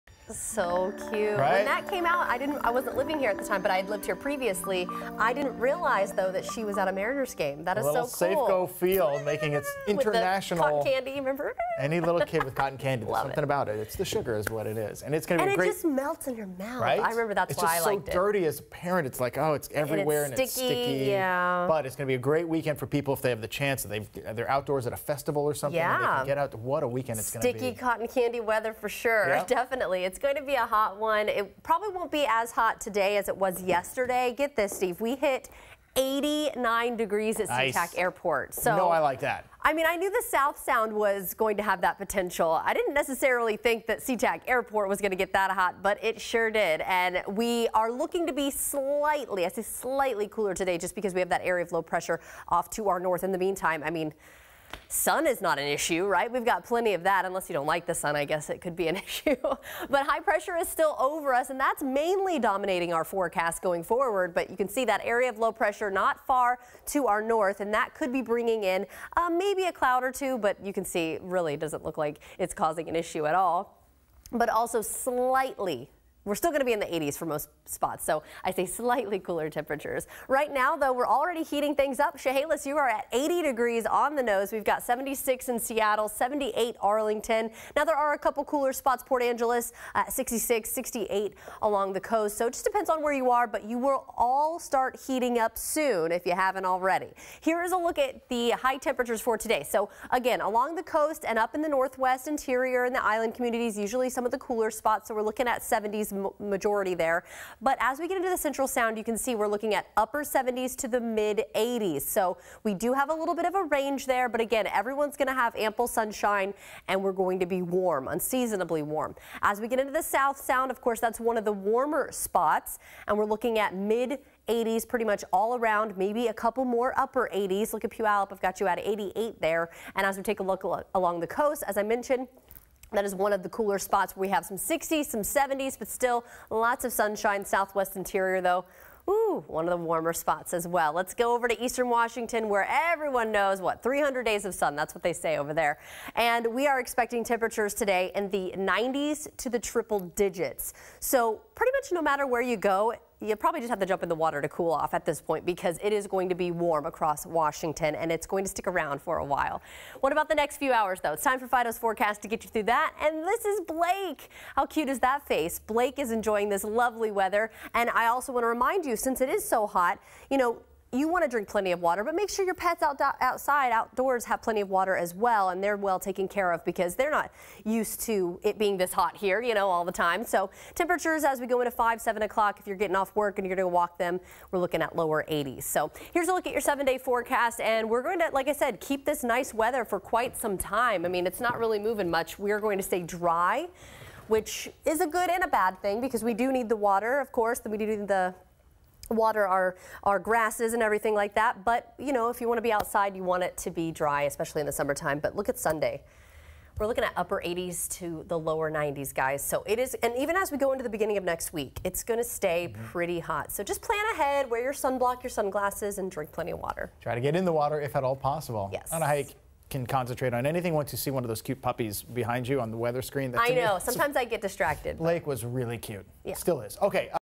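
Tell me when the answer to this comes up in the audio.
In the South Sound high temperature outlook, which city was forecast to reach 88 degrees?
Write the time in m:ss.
2:07.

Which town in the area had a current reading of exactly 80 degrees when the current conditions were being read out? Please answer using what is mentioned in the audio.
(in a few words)
Chehalis.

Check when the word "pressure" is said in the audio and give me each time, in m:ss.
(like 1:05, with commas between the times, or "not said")
0:51, 1:00, 1:05.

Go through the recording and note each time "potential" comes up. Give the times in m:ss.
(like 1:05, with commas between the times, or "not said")
0:41.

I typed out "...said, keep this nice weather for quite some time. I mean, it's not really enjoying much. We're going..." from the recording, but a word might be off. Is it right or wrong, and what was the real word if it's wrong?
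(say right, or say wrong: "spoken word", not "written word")
wrong: "moving", not "enjoying".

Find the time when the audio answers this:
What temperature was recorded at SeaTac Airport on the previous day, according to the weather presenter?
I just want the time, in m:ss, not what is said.
0:35.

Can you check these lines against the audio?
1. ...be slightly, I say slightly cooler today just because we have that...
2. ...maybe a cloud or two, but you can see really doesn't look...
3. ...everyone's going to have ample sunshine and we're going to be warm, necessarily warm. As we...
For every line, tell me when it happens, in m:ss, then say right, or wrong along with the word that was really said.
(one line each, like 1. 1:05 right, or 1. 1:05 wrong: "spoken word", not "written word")
1. 0:48 right
2. 1:09 right
3. 1:54 wrong: "unseasonably", not "necessarily".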